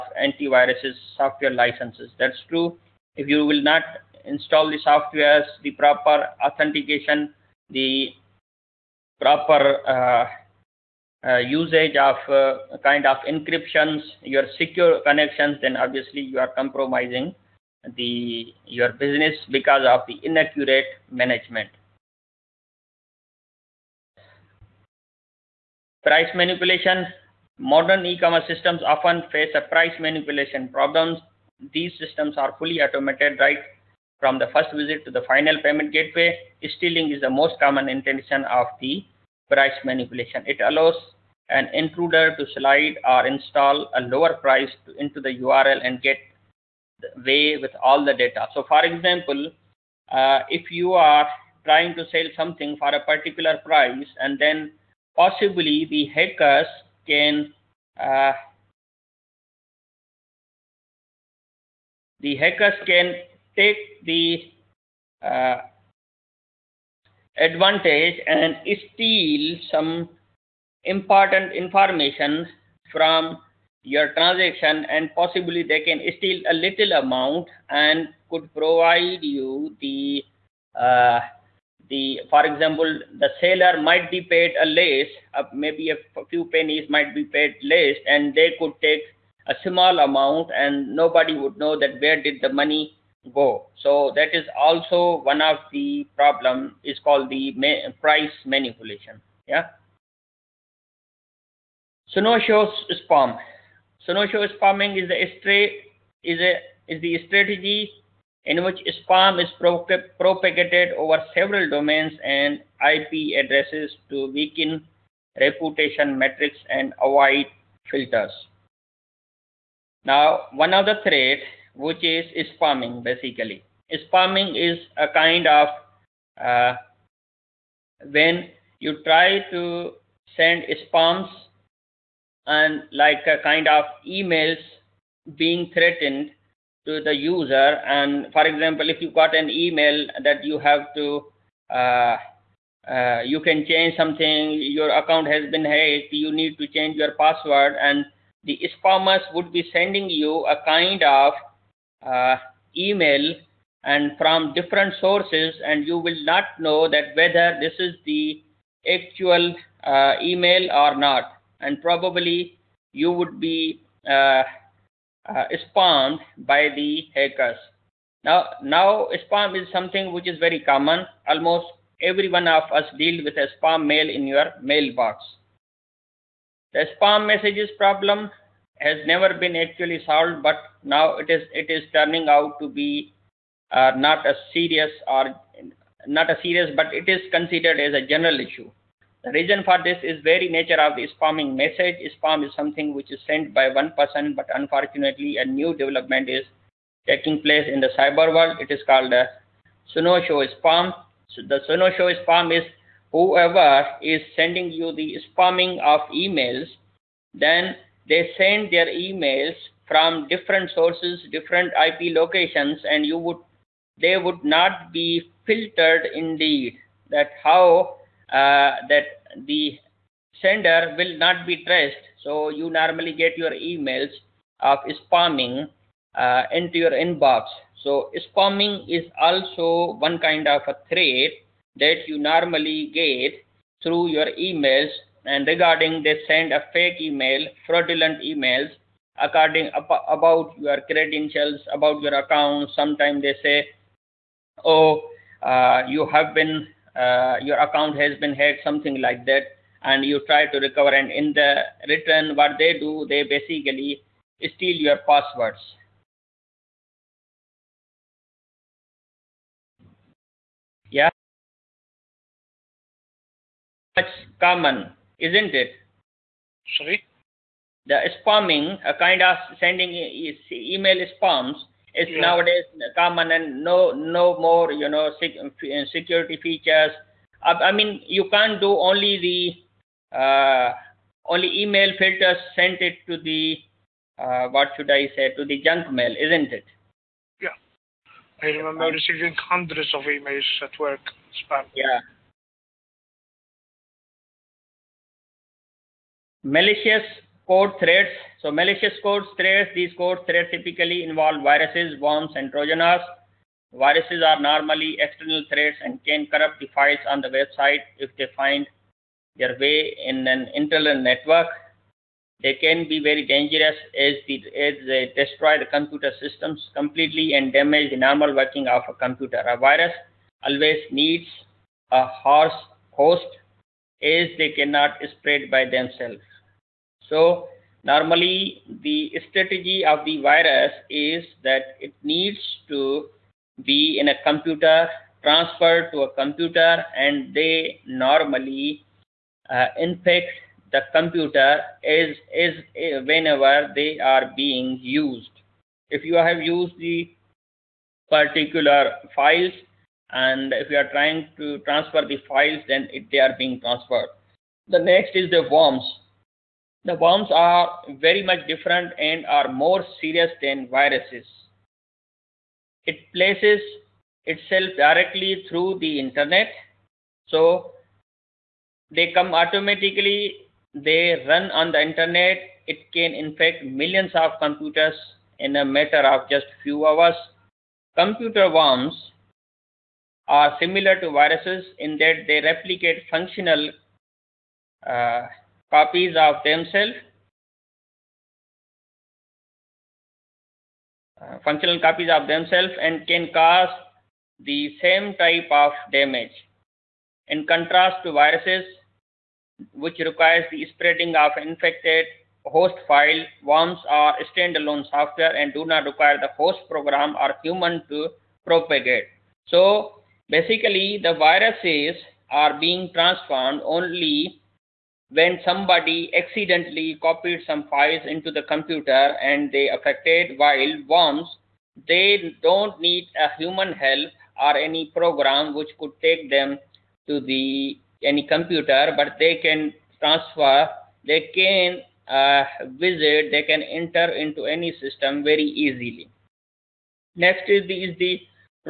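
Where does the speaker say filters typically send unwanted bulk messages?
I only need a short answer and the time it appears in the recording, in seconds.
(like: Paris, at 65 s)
junk mail, at 285 s.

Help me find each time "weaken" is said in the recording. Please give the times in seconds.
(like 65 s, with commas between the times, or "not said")
114 s.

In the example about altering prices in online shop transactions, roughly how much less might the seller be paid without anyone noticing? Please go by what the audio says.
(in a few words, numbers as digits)
a few pennies.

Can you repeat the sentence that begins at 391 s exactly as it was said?
Uh, functional copies of themselves and can cause the same type of damage.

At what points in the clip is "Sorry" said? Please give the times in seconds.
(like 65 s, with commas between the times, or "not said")
266 s.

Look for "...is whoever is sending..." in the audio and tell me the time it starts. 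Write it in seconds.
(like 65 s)
202 s.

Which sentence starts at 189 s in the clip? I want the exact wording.
The reason for this is very nature of the spamming message.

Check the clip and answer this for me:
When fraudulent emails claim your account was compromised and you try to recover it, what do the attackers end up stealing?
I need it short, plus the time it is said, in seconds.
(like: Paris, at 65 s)
your passwords, at 254 s.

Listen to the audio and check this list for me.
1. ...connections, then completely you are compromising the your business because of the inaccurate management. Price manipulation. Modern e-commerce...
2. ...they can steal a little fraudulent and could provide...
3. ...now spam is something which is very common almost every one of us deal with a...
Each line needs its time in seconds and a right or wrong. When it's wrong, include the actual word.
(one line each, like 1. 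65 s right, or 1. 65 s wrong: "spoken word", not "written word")
1. 15 s wrong: "obviously", not "completely"
2. 75 s wrong: "amount", not "fraudulent"
3. 168 s right.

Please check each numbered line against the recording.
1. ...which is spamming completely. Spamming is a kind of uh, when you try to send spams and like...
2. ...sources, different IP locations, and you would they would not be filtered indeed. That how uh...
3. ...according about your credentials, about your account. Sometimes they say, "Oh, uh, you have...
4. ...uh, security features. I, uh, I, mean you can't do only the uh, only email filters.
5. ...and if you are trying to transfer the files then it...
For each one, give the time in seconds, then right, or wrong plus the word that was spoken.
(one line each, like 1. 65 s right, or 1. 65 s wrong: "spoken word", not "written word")
1. 121 s wrong: "basically", not "completely"
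2. 210 s right
3. 239 s right
4. 275 s right
5. 350 s right.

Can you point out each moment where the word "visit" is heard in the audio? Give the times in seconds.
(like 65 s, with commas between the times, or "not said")
34 s, 432 s.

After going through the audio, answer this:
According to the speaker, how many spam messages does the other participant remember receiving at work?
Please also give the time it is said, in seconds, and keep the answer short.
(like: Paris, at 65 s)
hundreds, at 289 s.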